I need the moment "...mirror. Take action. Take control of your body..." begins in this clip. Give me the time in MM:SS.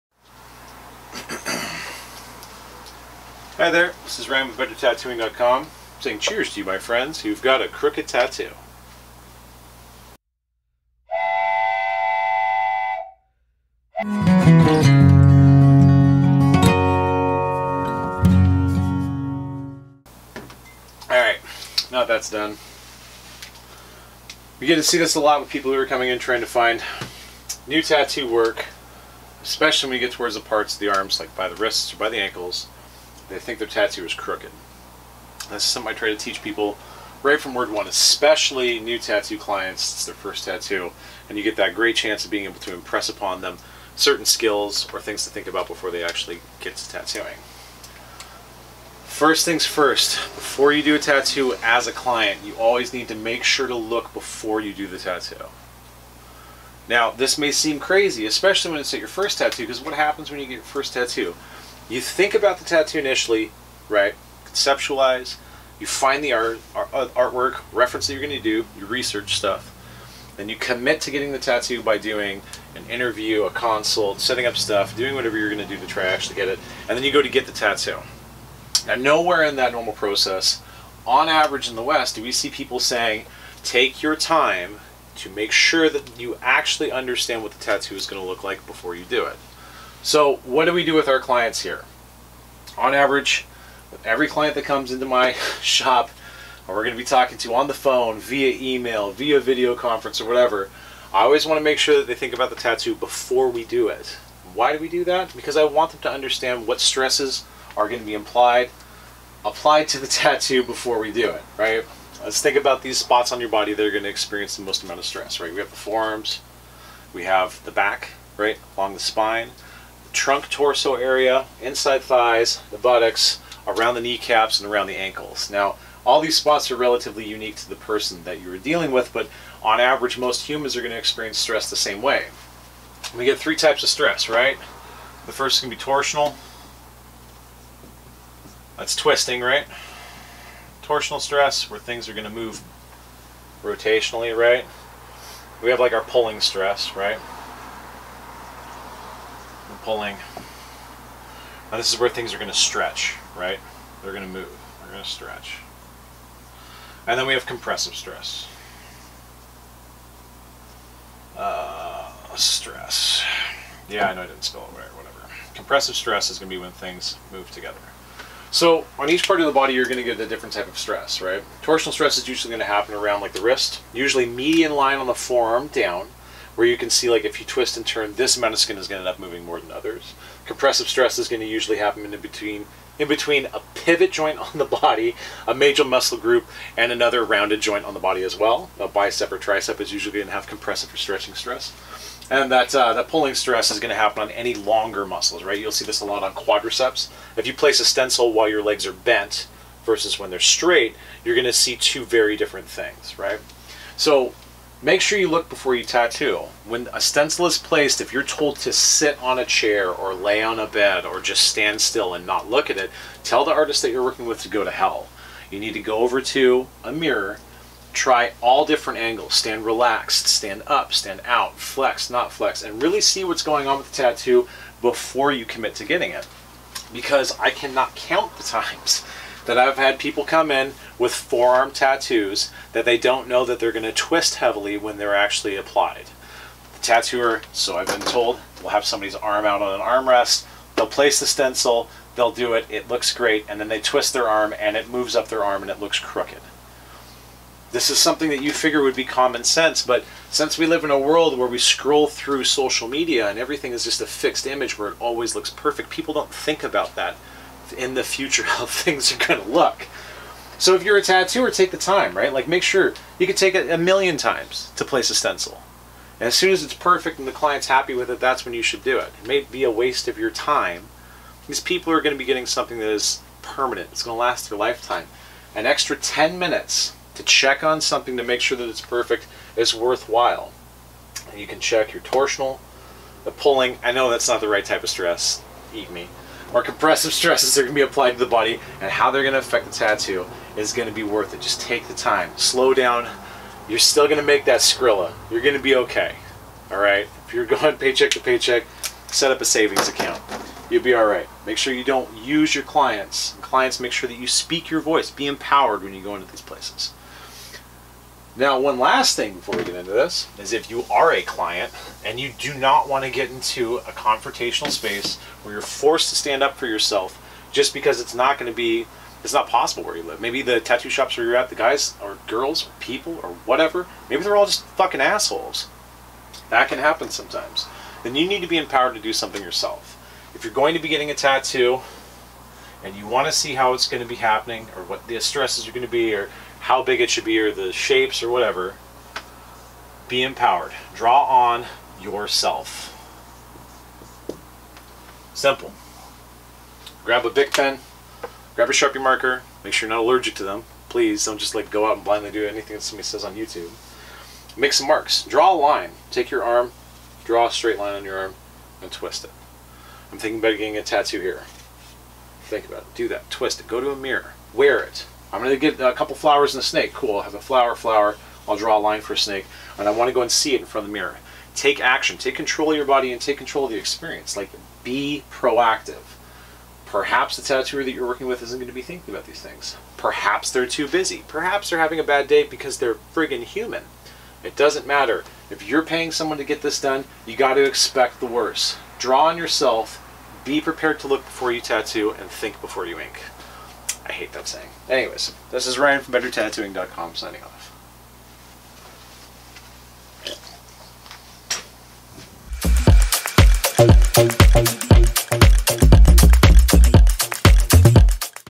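06:10.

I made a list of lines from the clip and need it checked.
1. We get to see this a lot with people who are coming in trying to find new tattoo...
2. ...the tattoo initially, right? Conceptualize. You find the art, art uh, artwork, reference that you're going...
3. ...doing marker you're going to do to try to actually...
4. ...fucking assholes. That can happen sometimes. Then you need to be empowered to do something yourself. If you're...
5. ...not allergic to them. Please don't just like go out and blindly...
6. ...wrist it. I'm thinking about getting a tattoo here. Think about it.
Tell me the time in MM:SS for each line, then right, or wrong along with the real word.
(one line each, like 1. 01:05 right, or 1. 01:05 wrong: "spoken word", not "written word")
1. 00:24 right
2. 01:02 right
3. 01:14 wrong: "whatever", not "marker"
4. 05:24 right
5. 05:49 right
6. 05:58 wrong: "twist", not "wrist".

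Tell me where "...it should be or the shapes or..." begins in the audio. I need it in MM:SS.
05:37.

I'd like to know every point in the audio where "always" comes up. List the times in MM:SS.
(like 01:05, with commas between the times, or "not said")
00:52, 01:41, 04:15.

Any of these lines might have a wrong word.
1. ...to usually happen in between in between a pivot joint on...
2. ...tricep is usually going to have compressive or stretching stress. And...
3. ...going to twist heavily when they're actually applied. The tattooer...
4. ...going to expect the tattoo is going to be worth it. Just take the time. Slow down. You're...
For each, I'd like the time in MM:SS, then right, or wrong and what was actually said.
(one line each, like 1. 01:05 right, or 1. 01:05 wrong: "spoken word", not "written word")
1. 03:01 right
2. 03:09 right
3. 03:53 right
4. 04:49 wrong: "affect", not "expect".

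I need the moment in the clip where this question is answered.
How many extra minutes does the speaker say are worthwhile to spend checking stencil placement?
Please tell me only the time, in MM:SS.
04:35.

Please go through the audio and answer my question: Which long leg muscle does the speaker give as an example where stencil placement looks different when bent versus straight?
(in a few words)
Quadriceps.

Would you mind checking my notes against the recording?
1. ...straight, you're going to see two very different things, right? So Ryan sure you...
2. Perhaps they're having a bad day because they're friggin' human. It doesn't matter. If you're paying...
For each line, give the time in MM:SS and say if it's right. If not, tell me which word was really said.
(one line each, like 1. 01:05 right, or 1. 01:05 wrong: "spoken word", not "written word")
1. 03:20 wrong: "Make", not "Ryan"
2. 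06:21 right.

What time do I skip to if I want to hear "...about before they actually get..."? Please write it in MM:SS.
00:45.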